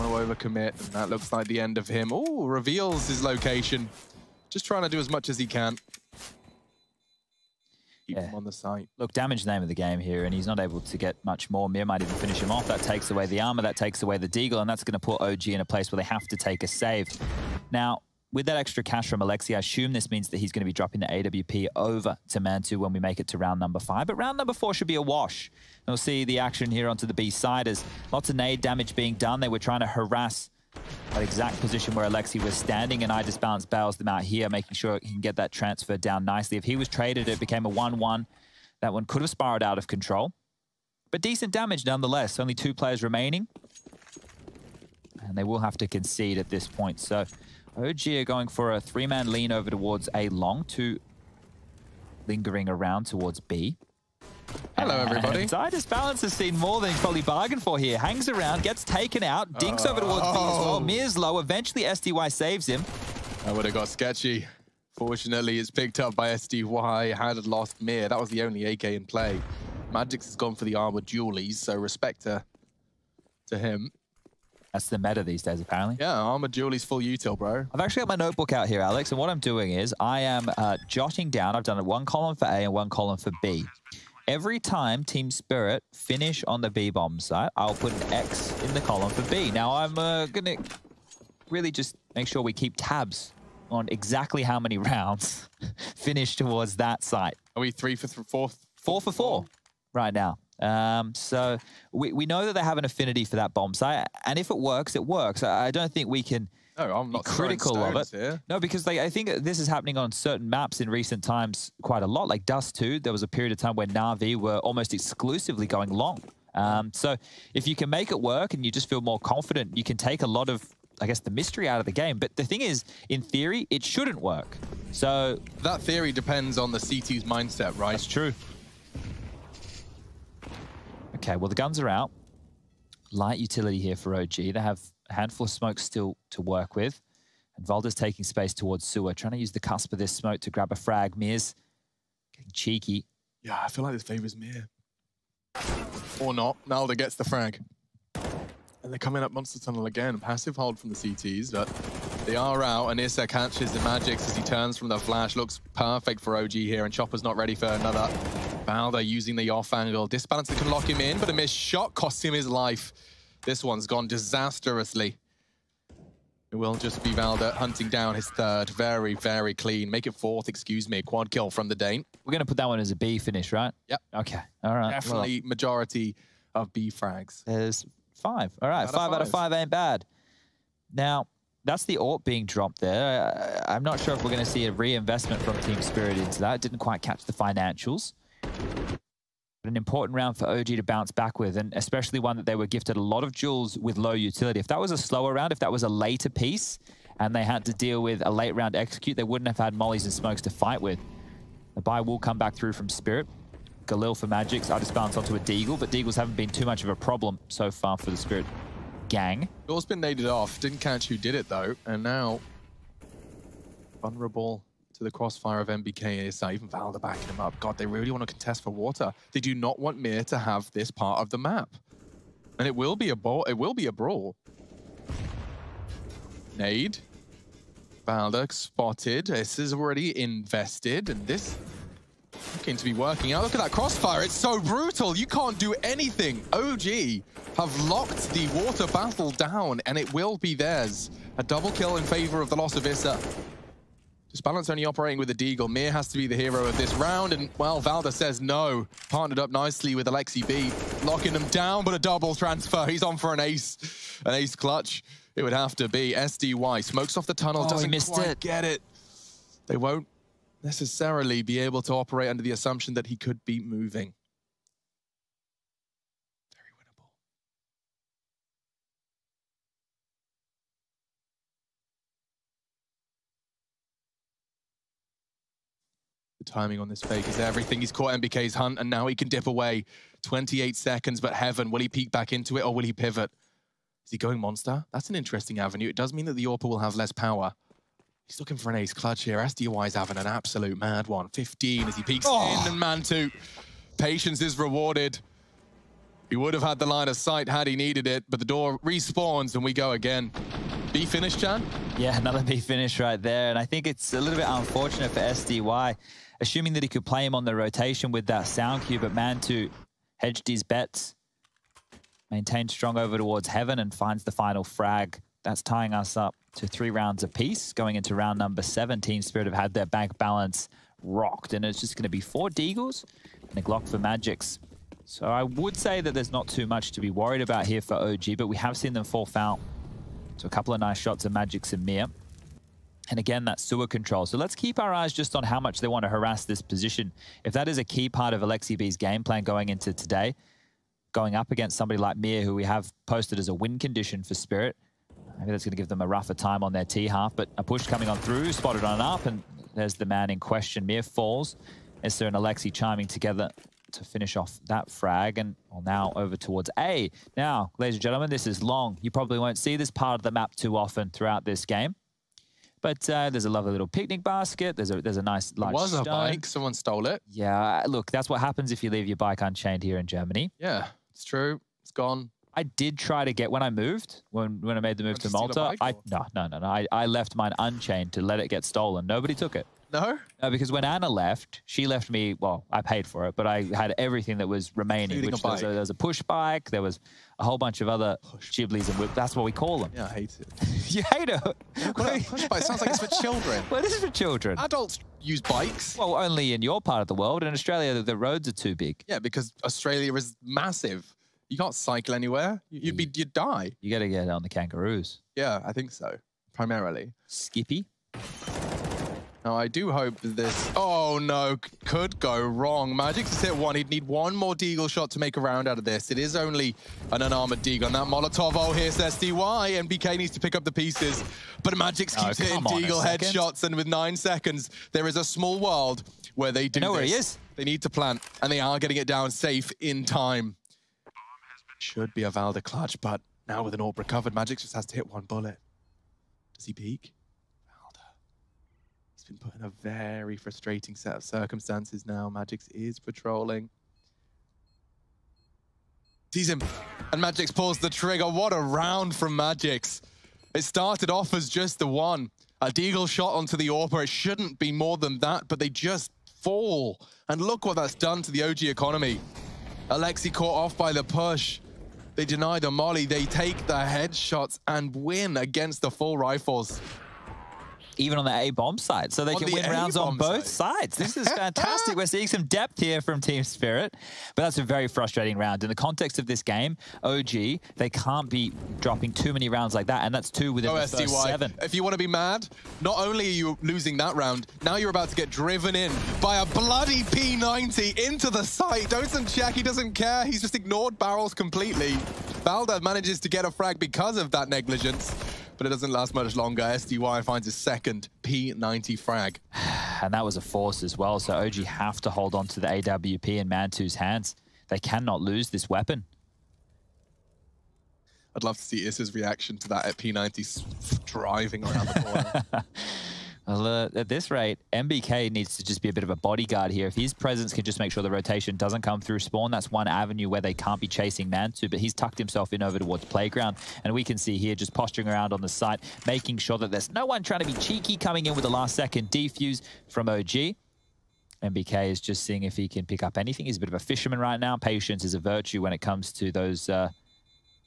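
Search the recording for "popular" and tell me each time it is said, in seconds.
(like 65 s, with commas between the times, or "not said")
not said.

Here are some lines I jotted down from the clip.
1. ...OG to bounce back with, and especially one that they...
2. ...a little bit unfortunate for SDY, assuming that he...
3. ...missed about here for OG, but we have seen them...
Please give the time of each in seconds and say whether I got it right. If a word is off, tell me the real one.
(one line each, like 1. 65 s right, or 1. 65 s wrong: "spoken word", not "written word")
1. 190 s right
2. 304 s right
3. 327 s wrong: "worried", not "missed".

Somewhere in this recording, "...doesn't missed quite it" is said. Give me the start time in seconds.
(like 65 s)
257 s.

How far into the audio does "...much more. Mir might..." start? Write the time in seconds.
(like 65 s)
11 s.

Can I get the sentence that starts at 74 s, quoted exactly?
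That's the meta these days, apparently.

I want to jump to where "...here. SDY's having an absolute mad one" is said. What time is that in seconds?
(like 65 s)
289 s.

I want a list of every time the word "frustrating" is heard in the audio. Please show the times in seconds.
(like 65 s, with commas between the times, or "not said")
440 s, 474 s.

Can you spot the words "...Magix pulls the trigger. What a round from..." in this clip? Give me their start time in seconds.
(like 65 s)
447 s.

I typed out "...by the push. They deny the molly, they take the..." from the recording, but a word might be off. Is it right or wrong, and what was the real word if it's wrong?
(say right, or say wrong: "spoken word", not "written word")
right.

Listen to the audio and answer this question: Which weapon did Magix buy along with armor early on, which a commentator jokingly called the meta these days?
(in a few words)
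Dualies.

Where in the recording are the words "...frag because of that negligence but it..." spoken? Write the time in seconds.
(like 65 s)
493 s.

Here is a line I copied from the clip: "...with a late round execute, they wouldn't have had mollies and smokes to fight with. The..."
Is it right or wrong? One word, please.
right.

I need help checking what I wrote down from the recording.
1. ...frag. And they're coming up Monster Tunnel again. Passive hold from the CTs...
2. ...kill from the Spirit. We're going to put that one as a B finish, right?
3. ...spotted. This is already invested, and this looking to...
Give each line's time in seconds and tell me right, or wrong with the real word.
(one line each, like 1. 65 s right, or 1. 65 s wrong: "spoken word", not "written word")
1. 147 s right
2. 171 s wrong: "Dane", not "Spirit"
3. 228 s right.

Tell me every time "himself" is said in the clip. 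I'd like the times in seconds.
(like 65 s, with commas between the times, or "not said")
522 s.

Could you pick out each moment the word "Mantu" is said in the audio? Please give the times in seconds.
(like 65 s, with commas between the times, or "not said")
22 s, 292 s, 309 s, 503 s, 521 s.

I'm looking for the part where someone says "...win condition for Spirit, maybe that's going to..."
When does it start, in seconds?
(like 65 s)
343 s.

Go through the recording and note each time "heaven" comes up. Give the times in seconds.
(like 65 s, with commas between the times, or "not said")
281 s, 313 s.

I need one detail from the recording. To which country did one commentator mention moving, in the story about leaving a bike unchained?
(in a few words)
Malta.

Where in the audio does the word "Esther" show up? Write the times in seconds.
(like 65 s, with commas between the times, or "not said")
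352 s.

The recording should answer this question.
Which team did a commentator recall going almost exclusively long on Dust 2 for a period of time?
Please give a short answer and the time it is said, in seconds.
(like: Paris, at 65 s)
Na'Vi, at 113 s.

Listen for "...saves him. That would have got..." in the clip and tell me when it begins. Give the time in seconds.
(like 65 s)
62 s.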